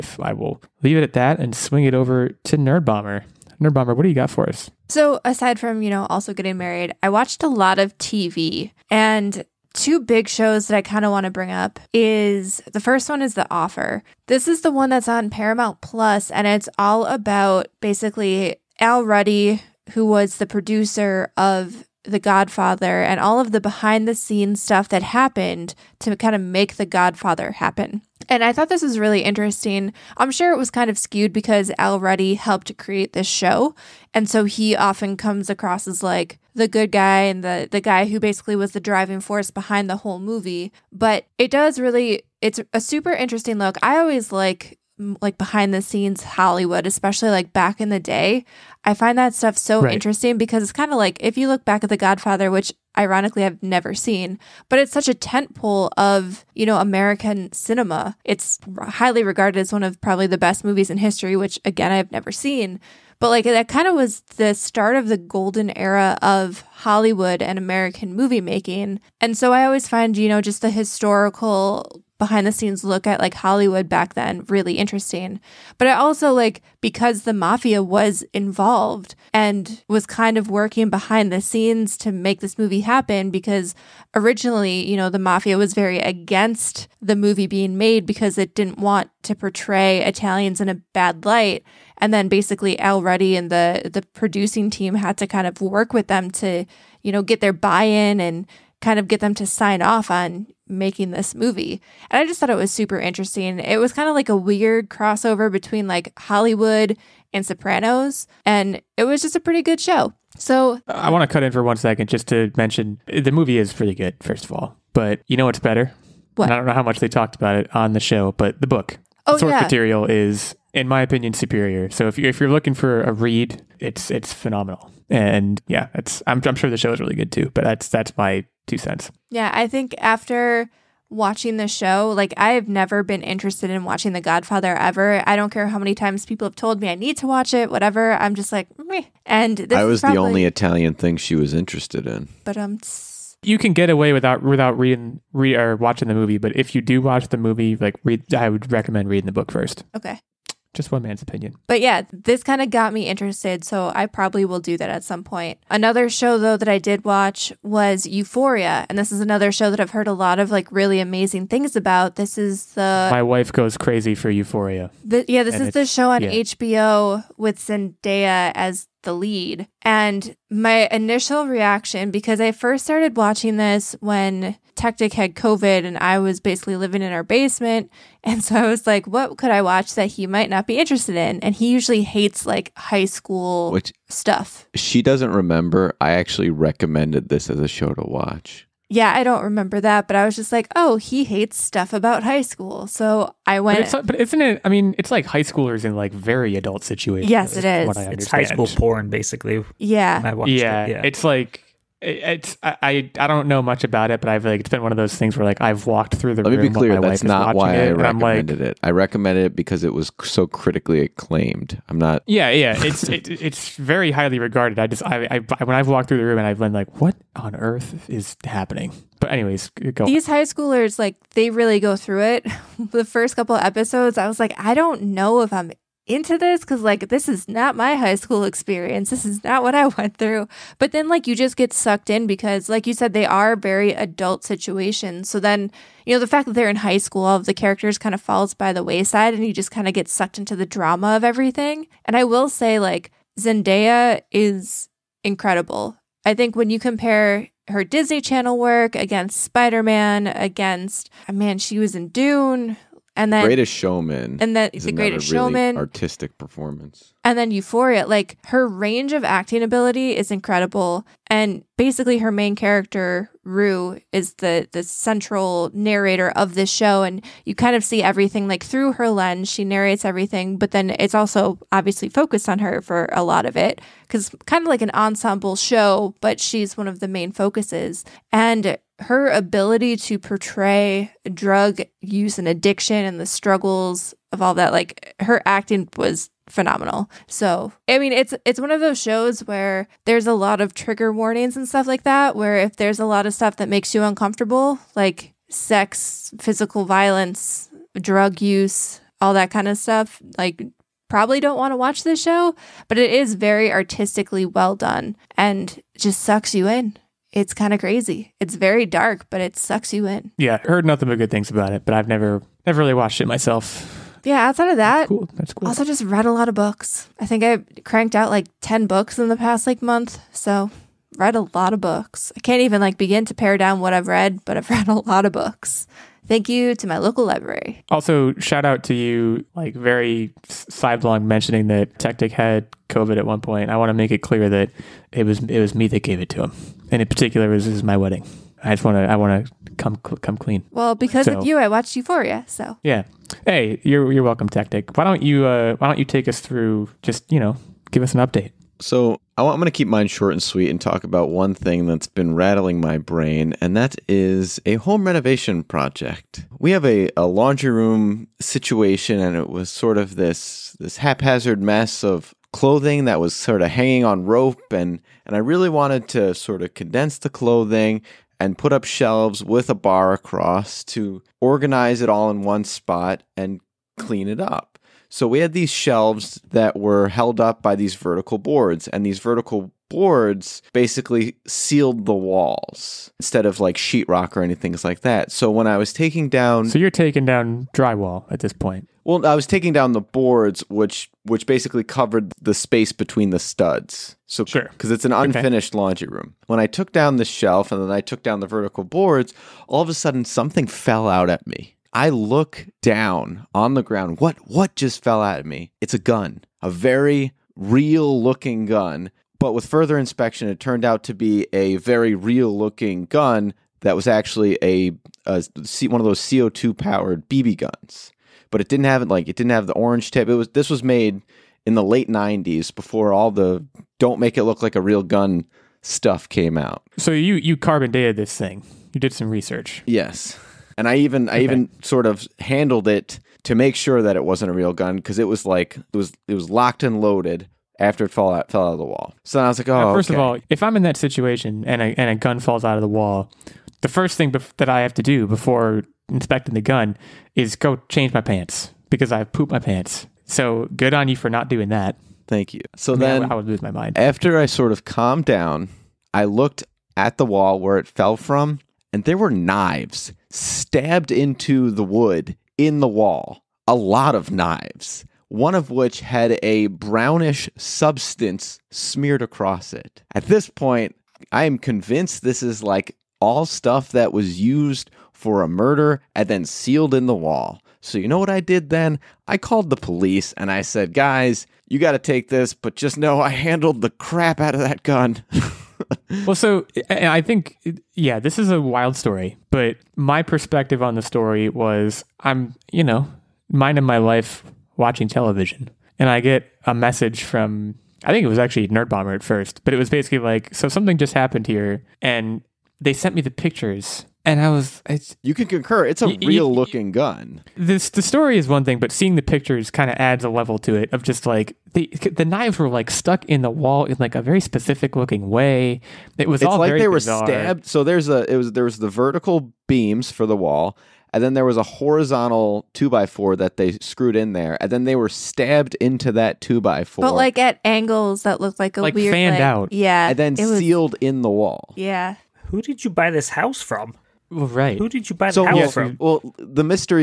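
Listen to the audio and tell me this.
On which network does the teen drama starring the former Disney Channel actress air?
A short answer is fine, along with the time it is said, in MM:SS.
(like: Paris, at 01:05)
HBO, at 02:46.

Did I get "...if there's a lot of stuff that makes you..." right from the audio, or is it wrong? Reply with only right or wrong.
right.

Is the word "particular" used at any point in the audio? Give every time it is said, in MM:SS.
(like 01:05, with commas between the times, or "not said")
05:37.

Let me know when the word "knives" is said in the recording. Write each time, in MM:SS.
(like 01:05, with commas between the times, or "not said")
07:39, 07:44, 08:32.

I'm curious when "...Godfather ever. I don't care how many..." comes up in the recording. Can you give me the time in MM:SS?
02:14.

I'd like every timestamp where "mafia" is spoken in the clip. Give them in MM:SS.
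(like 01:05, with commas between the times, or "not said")
01:17, 01:25.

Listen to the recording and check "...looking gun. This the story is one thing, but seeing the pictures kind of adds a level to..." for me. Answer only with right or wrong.
right.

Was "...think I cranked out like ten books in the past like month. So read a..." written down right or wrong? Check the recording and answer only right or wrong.
right.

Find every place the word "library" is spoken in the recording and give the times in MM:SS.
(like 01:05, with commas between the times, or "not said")
05:27.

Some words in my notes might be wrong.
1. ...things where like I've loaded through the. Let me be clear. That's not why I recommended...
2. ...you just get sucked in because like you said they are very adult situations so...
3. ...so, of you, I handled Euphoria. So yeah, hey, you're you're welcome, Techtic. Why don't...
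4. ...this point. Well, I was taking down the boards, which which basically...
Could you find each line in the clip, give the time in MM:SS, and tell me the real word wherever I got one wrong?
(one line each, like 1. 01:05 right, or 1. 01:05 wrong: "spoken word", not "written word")
1. 03:25 wrong: "walked", not "loaded"
2. 03:51 right
3. 05:41 wrong: "watched", not "handled"
4. 06:28 right.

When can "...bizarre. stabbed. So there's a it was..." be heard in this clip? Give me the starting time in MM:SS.
08:36.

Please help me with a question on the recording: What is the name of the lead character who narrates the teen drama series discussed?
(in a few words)
Rue.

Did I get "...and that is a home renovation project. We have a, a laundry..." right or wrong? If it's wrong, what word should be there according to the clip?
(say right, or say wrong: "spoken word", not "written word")
right.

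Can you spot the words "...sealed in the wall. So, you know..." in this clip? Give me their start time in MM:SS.
07:56.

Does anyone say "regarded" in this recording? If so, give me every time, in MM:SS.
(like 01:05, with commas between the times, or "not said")
00:59, 03:34.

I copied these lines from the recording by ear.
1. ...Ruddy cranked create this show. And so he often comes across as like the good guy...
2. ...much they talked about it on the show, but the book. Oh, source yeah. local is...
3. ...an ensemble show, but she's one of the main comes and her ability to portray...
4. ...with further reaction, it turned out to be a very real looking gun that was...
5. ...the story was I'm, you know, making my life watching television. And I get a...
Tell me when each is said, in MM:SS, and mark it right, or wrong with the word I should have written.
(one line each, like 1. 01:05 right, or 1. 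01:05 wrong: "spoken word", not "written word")
1. 00:31 wrong: "helped", not "cranked"
2. 01:56 wrong: "material", not "local"
3. 04:34 wrong: "focuses", not "comes"
4. 06:49 wrong: "inspection", not "reaction"
5. 08:10 wrong: "minding", not "making".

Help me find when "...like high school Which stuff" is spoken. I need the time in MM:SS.
03:02.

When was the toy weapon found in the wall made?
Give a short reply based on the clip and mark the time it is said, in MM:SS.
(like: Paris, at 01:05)
late '90s, at 07:01.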